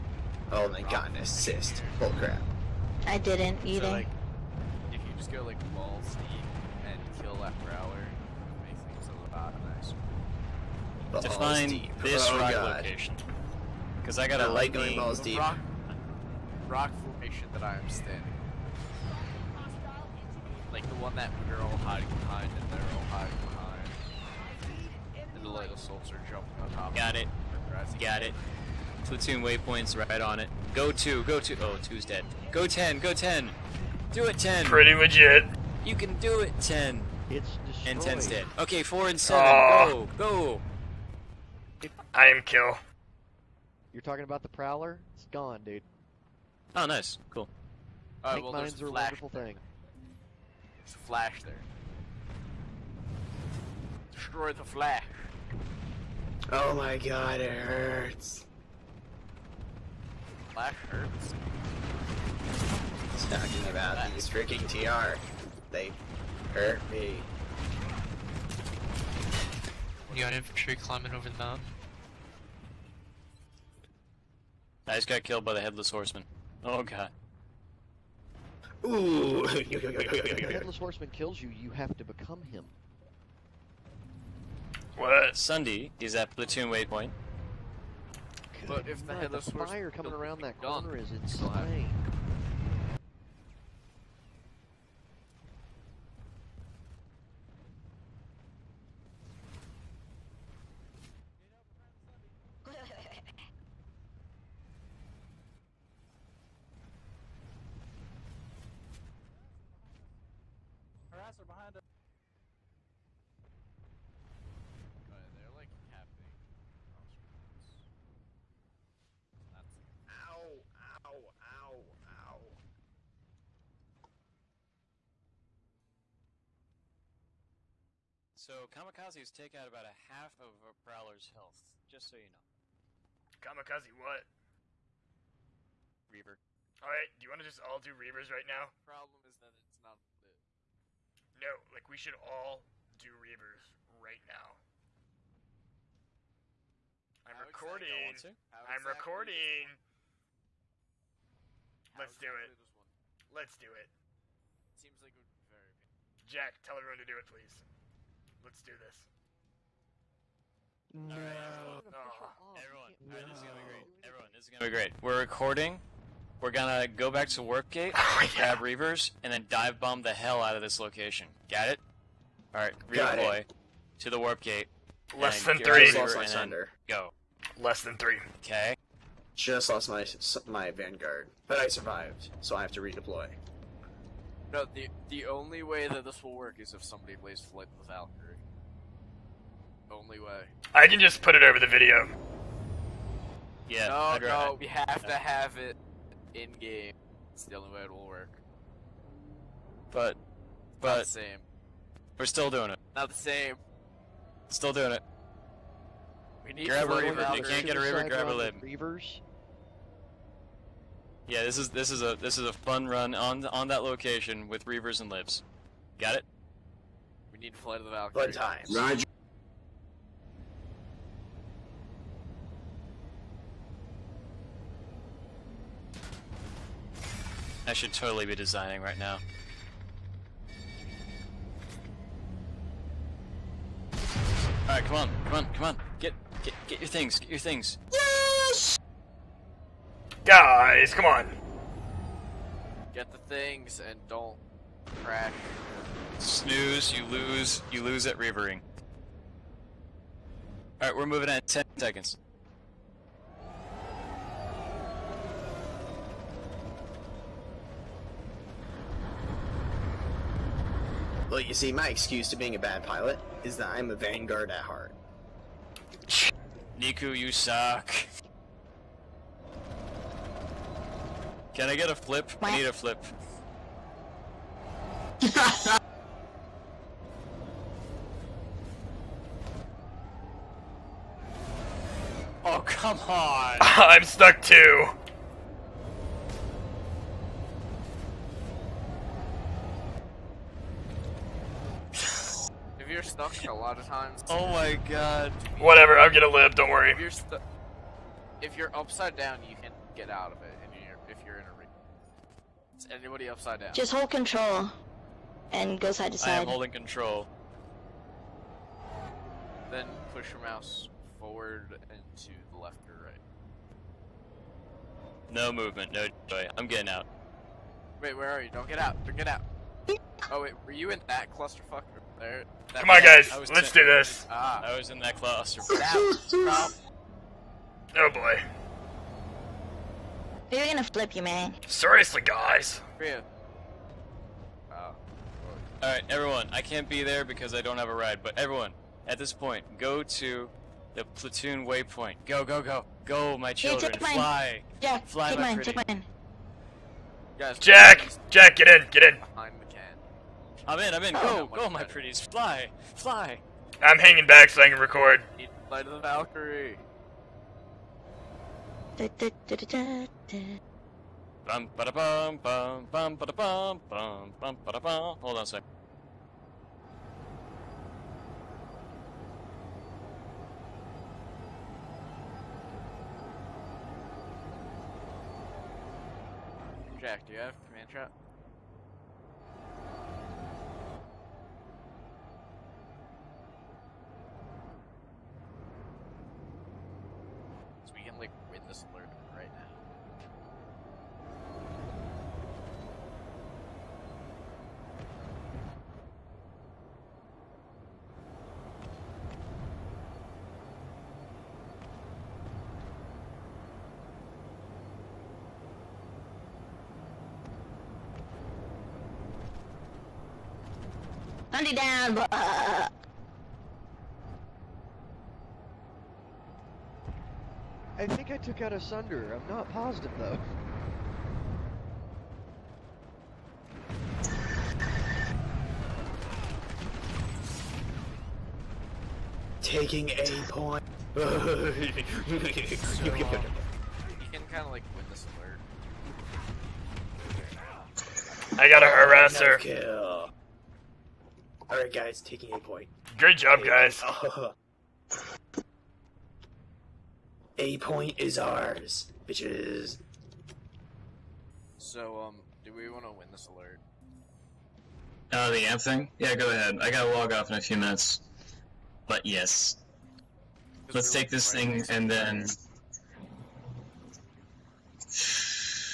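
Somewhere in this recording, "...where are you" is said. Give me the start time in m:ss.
5:18.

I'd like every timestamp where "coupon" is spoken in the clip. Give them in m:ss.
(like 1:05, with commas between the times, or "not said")
not said.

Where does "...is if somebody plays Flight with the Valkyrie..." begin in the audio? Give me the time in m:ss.
3:06.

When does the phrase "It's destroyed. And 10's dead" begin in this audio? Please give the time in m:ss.
0:37.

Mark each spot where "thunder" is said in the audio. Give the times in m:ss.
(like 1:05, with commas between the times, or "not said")
2:56.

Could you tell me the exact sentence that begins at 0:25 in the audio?
And the little soldier jumping on top Got it.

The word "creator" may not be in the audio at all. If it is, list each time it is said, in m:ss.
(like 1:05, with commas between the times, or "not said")
not said.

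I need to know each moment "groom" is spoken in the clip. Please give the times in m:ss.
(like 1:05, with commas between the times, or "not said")
not said.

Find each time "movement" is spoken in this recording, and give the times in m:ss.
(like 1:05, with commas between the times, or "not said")
5:15.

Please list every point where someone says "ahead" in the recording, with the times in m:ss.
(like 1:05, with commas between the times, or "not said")
7:36.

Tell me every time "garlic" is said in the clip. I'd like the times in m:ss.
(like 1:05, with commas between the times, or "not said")
not said.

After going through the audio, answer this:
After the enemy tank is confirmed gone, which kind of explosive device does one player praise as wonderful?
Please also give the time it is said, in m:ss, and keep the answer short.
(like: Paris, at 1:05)
Mines, at 0:48.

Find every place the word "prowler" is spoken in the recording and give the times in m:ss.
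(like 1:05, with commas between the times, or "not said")
0:07, 0:44, 2:10.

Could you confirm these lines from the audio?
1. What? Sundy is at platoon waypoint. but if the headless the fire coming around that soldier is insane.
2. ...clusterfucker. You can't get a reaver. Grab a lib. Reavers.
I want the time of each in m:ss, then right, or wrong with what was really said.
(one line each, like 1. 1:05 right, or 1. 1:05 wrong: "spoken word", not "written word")
1. 1:24 wrong: "corner", not "soldier"
2. 3:26 wrong: "reaver", not "clusterfucker".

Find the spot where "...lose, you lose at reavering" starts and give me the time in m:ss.
4:07.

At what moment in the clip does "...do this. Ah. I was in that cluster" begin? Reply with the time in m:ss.
5:23.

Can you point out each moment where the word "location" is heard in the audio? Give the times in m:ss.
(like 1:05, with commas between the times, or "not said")
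0:12, 2:50, 3:33.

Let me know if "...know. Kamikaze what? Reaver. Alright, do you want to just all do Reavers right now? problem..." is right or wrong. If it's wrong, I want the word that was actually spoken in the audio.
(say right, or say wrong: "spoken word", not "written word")
right.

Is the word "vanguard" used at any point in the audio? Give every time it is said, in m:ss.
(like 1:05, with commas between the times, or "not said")
3:00, 4:23.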